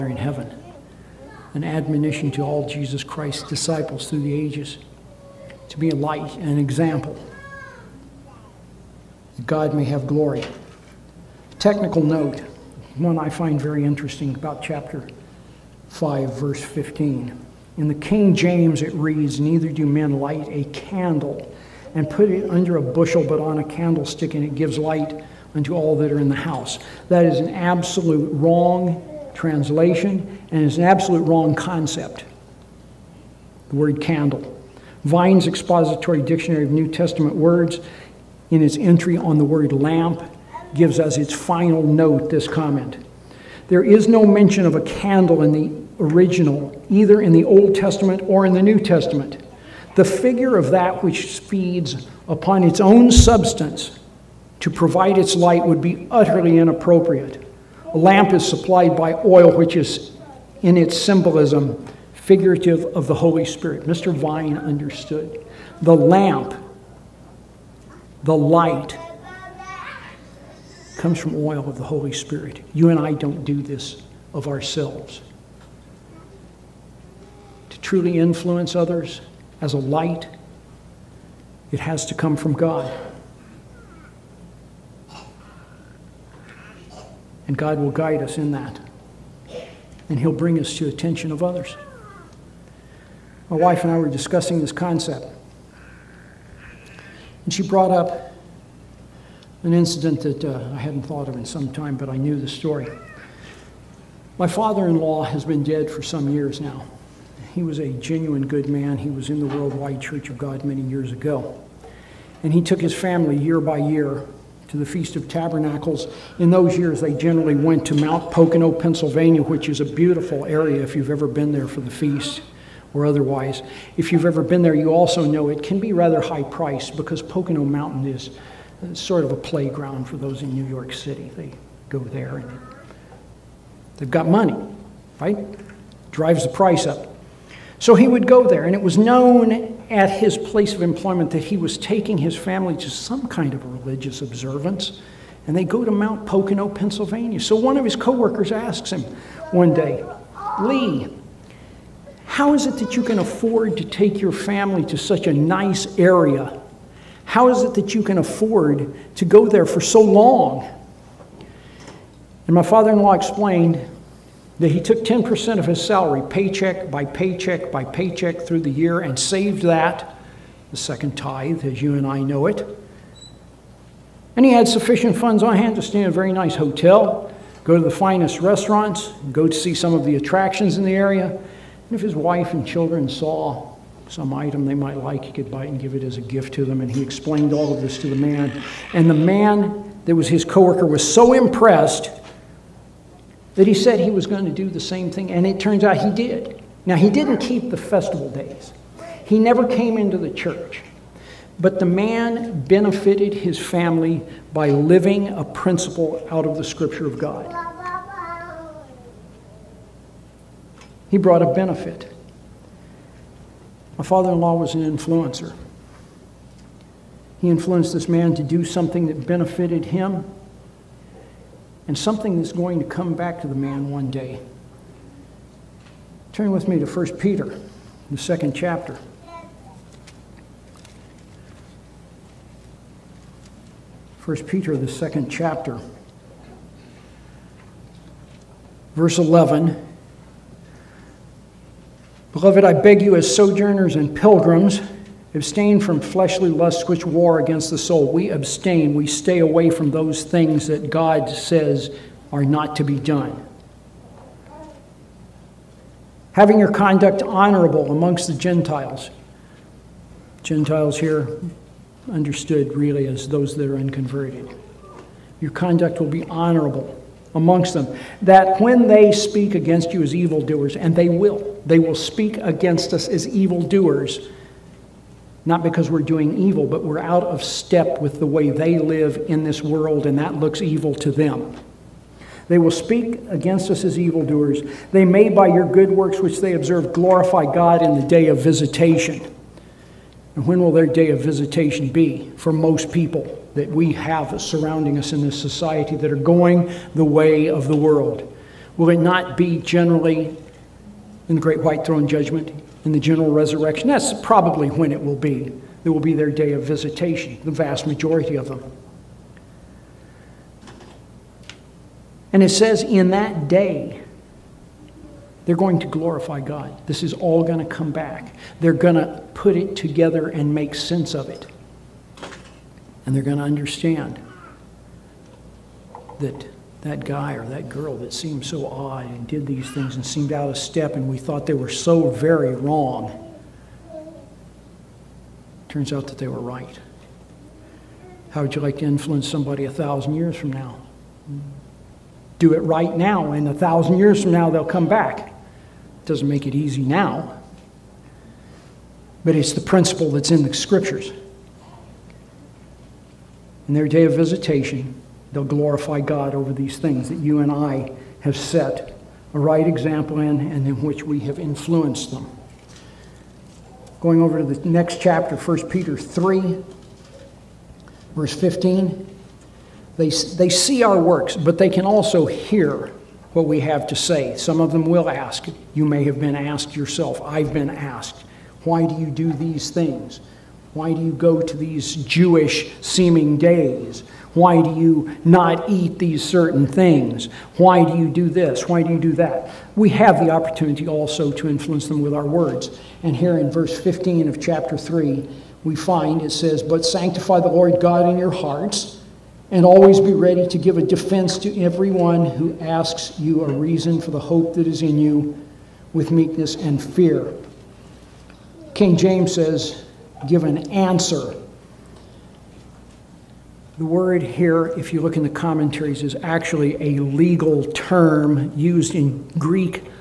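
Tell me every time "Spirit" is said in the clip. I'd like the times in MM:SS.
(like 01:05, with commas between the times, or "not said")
01:03, 01:12.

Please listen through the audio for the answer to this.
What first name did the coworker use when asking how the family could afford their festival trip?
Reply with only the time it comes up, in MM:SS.
02:30.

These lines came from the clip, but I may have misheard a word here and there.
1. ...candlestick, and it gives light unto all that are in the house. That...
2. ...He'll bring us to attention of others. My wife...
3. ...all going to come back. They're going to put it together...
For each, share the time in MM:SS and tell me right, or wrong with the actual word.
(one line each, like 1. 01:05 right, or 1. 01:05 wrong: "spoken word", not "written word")
1. 00:23 right
2. 01:30 right
3. 05:17 right.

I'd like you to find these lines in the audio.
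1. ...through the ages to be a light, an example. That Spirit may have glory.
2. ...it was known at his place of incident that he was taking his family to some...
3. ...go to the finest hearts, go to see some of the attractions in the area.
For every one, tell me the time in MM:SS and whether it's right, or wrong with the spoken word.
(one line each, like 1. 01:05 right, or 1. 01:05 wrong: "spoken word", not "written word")
1. 00:04 wrong: "God", not "Spirit"
2. 02:18 wrong: "employment", not "incident"
3. 02:57 wrong: "restaurants", not "hearts".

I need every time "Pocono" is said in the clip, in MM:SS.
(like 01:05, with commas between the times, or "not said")
01:58, 02:07, 02:26.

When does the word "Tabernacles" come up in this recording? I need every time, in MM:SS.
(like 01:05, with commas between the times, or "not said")
01:55.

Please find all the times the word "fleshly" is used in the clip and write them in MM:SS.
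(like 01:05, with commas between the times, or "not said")
04:06.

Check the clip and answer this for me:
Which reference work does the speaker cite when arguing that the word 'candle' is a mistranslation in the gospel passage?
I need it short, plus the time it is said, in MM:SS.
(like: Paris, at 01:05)
Vine's Expository Dictionary, at 00:35.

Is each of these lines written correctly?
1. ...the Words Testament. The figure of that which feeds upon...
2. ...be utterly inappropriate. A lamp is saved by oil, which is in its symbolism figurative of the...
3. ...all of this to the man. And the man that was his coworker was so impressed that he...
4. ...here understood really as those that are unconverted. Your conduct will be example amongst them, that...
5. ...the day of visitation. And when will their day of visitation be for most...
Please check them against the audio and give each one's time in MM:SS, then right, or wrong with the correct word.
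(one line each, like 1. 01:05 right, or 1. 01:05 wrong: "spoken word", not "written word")
1. 00:48 wrong: "New", not "Words"
2. 00:55 wrong: "supplied", not "saved"
3. 03:07 right
4. 04:20 wrong: "honorable", not "example"
5. 04:47 right.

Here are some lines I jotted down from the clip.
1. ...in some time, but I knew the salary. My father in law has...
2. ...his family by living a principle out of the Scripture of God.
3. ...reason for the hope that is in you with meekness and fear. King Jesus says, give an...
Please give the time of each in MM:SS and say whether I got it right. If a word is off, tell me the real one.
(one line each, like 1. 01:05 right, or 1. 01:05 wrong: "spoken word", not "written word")
1. 01:41 wrong: "story", not "salary"
2. 03:23 right
3. 06:43 wrong: "James", not "Jesus".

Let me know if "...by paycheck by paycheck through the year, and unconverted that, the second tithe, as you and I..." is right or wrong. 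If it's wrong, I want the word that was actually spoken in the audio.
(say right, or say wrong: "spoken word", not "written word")
wrong: "saved", not "unconverted".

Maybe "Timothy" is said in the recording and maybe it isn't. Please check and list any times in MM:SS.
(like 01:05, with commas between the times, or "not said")
not said.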